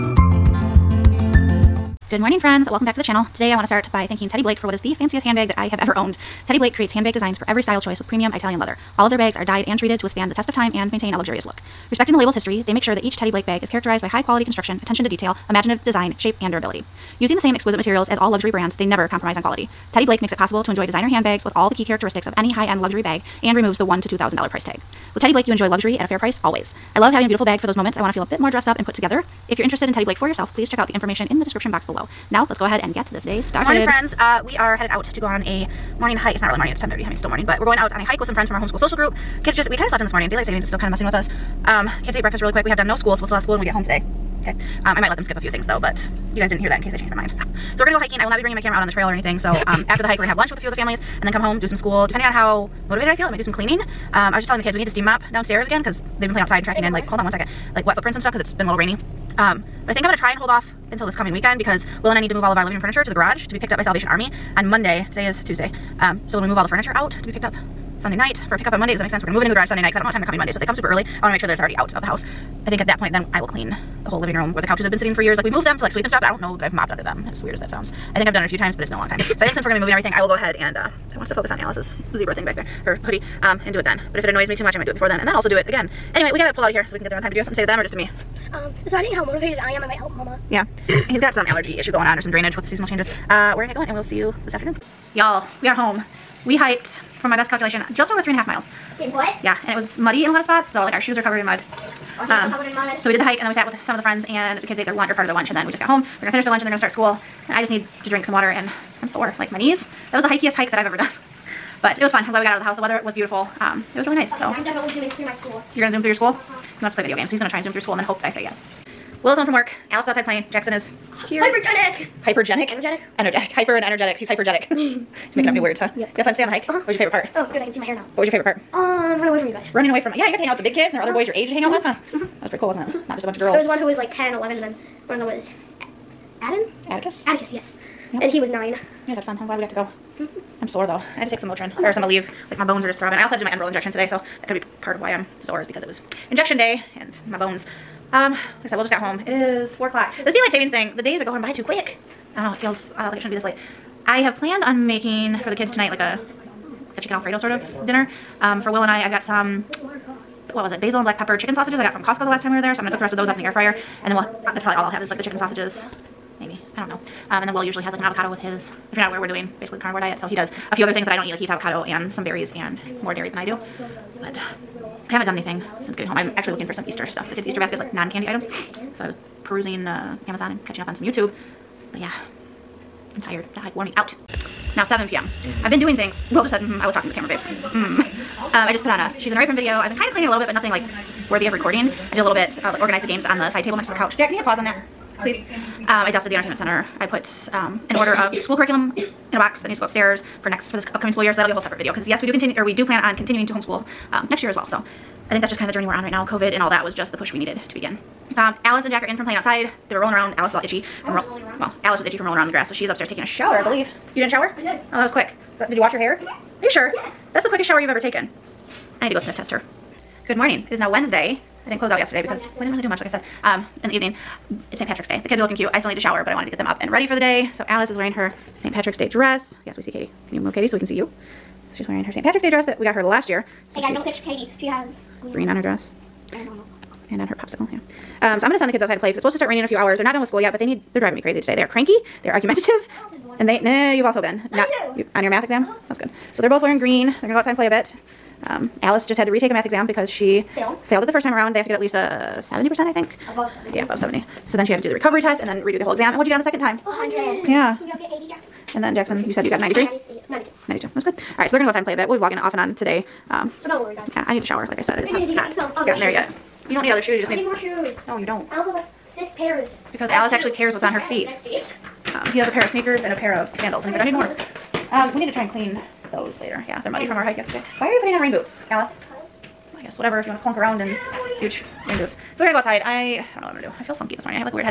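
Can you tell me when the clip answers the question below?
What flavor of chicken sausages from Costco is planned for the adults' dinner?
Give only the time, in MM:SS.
02:40.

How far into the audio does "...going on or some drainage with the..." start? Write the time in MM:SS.
01:31.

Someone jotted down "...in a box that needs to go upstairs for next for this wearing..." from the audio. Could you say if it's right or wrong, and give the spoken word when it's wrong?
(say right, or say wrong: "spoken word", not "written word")
wrong: "upcoming", not "wearing".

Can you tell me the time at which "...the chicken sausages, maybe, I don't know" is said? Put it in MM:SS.
02:45.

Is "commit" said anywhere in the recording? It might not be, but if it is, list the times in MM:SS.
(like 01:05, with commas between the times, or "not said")
not said.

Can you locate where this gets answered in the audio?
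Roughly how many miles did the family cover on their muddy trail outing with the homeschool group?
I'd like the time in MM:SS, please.
01:38.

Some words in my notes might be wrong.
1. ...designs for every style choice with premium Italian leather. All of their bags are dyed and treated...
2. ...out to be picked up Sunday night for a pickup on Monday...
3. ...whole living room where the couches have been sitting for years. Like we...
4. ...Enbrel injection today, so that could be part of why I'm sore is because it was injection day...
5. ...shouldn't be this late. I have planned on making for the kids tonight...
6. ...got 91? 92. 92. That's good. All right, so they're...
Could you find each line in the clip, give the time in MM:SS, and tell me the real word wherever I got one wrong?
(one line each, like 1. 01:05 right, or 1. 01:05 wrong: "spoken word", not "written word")
1. 00:07 right
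2. 01:06 right
3. 01:14 right
4. 02:23 right
5. 02:33 right
6. 04:19 wrong: "93", not "91".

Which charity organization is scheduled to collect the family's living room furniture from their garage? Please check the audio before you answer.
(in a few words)
Salvation Army.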